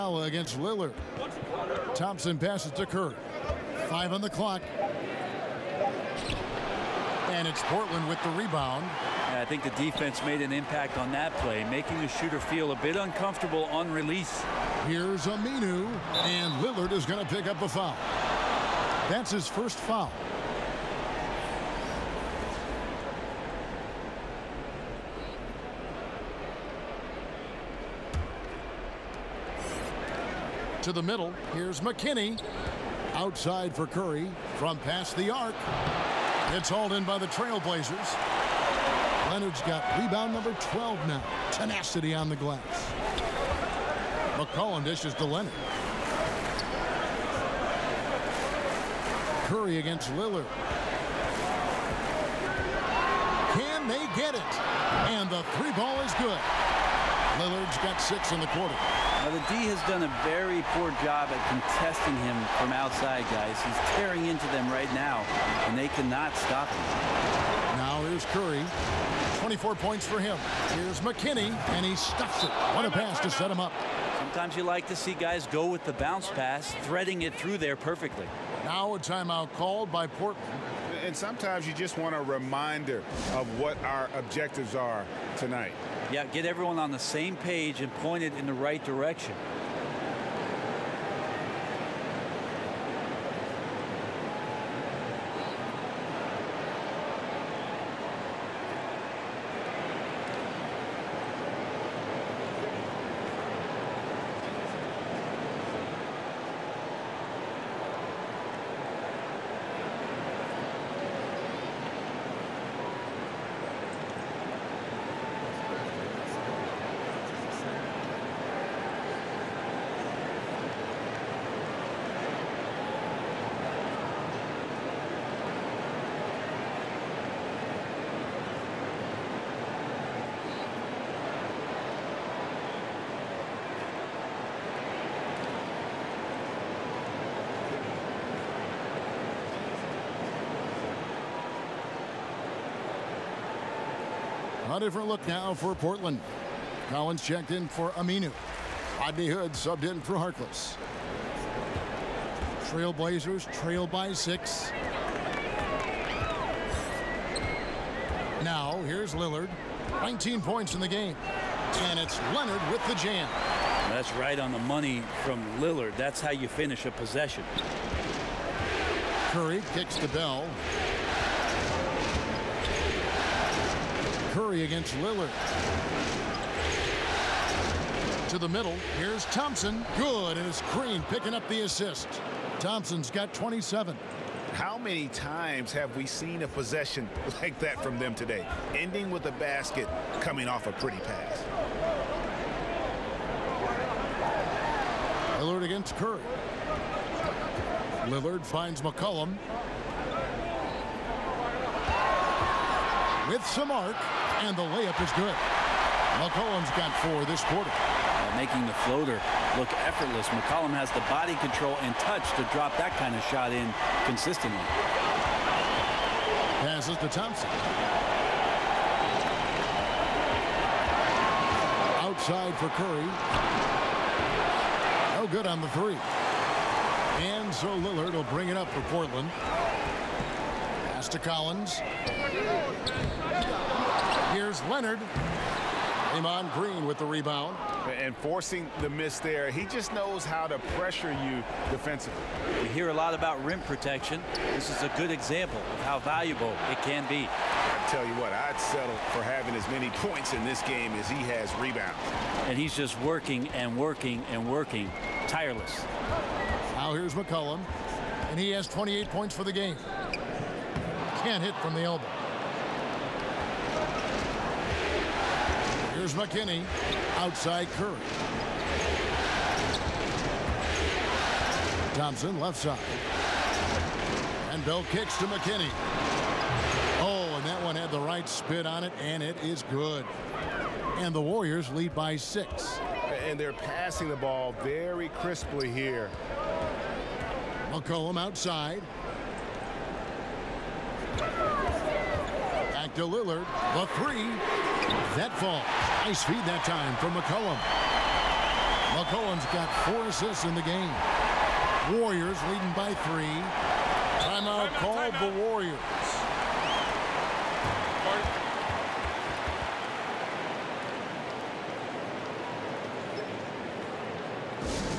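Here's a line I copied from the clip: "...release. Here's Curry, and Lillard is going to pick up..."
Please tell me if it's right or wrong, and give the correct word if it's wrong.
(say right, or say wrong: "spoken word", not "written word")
wrong: "Aminu", not "Curry".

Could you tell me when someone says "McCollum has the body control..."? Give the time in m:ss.
3:30.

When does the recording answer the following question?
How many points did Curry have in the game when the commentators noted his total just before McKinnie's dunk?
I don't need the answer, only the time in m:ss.
1:09.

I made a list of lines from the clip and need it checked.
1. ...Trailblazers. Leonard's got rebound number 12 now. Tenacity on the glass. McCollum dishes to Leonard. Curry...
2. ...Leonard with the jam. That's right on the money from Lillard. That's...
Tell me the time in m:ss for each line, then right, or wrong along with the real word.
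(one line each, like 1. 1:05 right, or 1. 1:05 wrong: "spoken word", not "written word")
1. 0:37 right
2. 2:42 right.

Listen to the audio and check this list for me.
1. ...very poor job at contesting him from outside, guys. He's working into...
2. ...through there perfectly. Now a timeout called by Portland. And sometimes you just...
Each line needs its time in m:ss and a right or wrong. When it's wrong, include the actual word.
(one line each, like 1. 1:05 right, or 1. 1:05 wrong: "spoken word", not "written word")
1. 1:00 wrong: "tearing", not "working"
2. 1:17 right.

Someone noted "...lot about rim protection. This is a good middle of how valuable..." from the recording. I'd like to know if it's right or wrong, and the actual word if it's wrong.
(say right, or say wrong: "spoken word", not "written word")
wrong: "example", not "middle".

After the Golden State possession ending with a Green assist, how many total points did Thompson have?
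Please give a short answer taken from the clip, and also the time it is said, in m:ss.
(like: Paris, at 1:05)
27, at 3:03.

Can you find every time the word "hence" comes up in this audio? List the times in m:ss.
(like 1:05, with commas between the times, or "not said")
not said.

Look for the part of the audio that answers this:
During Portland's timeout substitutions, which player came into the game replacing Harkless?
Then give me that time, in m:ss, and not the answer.
2:28.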